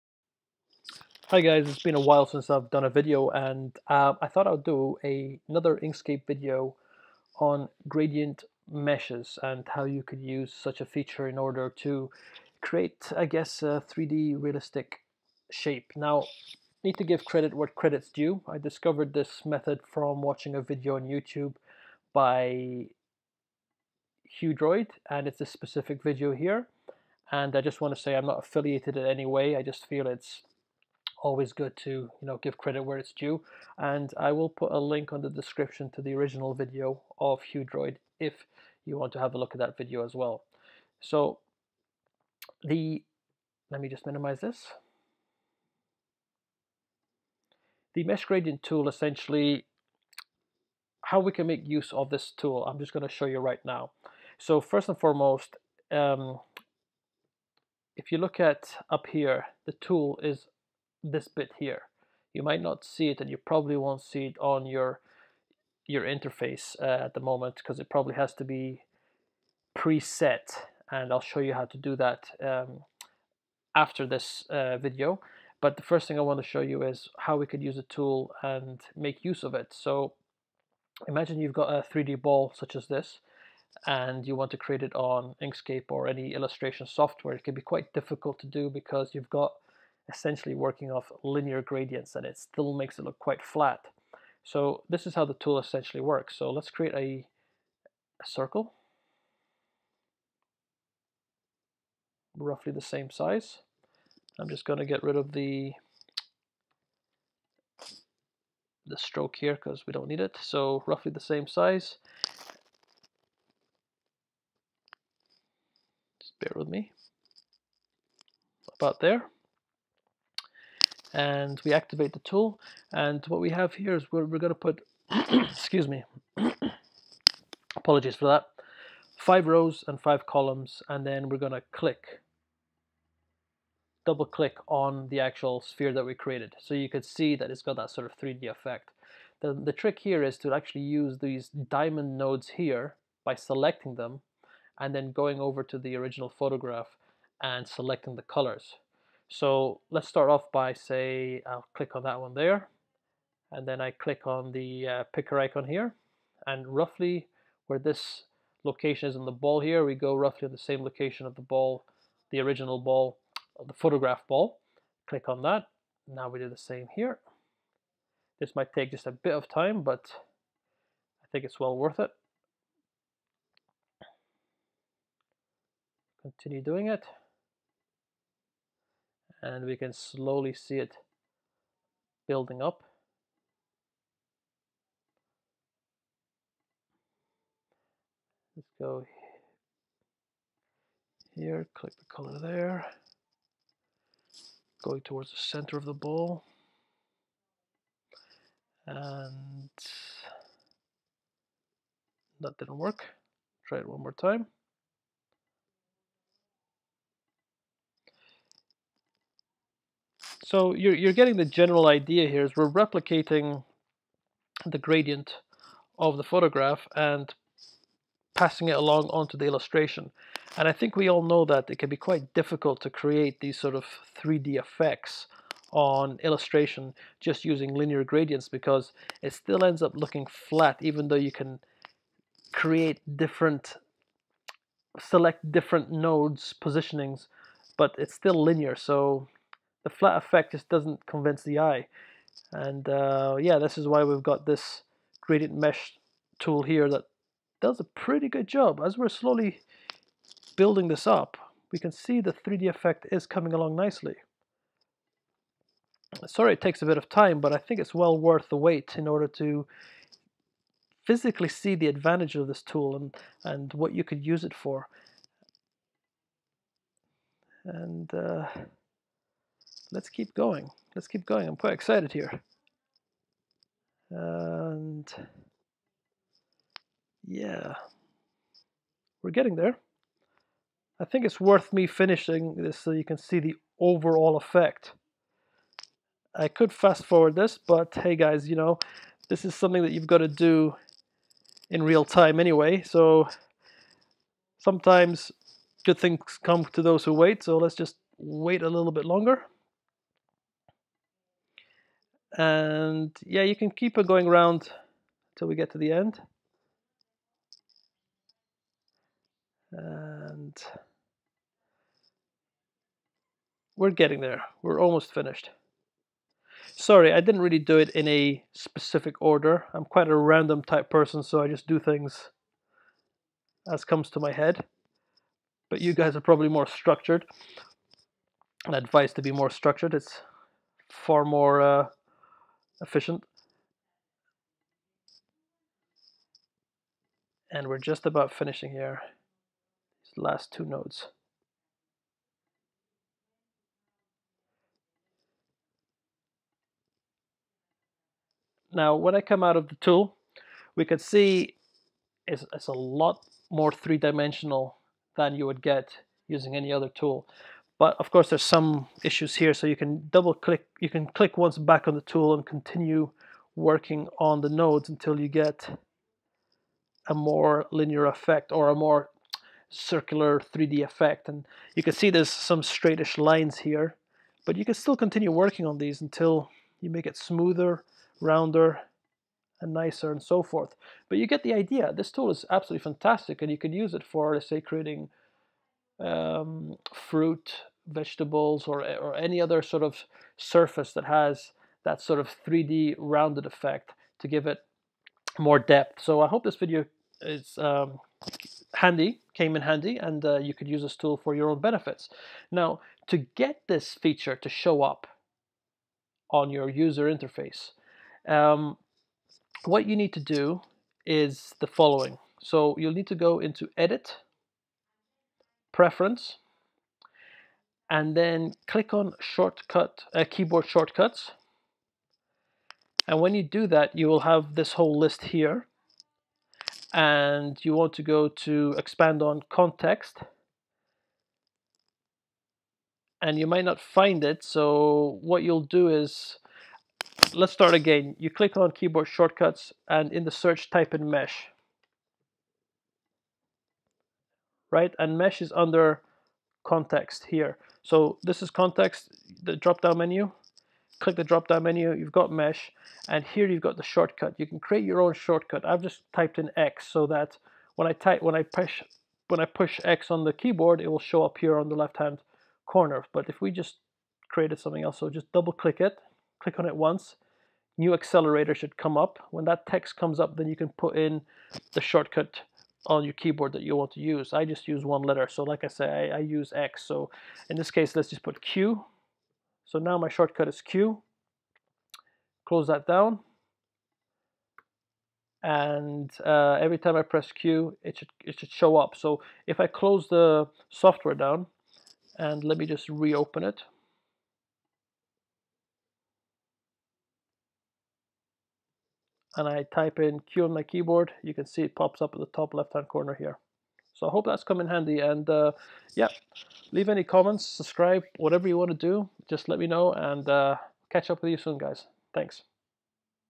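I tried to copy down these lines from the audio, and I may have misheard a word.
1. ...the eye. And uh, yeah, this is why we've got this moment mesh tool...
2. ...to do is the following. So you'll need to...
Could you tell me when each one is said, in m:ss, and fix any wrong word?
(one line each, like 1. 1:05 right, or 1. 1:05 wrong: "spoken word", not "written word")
1. 4:01 wrong: "gradient", not "moment"
2. 6:50 right.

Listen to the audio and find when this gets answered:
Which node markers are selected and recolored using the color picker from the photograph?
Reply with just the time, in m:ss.
2:21.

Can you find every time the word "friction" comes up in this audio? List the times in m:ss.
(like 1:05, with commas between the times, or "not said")
not said.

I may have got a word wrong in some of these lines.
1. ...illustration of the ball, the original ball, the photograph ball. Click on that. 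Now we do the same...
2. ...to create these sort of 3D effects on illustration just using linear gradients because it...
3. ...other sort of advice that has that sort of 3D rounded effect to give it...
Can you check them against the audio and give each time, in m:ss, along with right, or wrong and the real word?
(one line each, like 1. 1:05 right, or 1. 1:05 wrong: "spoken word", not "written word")
1. 2:40 wrong: "location", not "illustration"
2. 3:42 right
3. 6:29 wrong: "surface", not "advice".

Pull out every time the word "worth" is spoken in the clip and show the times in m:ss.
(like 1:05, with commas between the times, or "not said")
2:51, 4:18, 4:41.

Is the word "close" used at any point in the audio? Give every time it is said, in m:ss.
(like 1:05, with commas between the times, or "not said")
8:02, 8:09.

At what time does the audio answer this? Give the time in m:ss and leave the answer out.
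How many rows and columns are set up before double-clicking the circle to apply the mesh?
2:09.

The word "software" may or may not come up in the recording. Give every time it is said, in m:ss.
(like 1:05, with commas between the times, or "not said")
1:26, 8:10.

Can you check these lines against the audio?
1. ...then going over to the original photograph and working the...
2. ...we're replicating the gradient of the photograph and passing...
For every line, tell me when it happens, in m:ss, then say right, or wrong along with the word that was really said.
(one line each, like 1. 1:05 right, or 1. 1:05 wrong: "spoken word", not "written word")
1. 2:24 wrong: "selecting", not "working"
2. 3:32 right.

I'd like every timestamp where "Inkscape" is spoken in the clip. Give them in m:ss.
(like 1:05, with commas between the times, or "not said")
0:05, 1:25.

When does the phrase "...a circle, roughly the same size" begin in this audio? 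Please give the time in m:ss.
1:38.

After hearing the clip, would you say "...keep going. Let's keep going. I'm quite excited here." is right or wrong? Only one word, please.
right.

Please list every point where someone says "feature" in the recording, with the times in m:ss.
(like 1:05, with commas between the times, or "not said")
0:10, 6:43.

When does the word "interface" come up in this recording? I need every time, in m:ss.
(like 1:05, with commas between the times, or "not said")
1:06, 6:47.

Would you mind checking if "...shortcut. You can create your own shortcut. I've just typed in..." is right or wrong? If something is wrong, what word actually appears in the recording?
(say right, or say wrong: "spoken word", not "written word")
right.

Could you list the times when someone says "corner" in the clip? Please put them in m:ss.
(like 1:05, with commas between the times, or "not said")
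7:42, 8:22.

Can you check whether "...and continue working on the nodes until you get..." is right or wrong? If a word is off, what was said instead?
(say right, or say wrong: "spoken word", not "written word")
right.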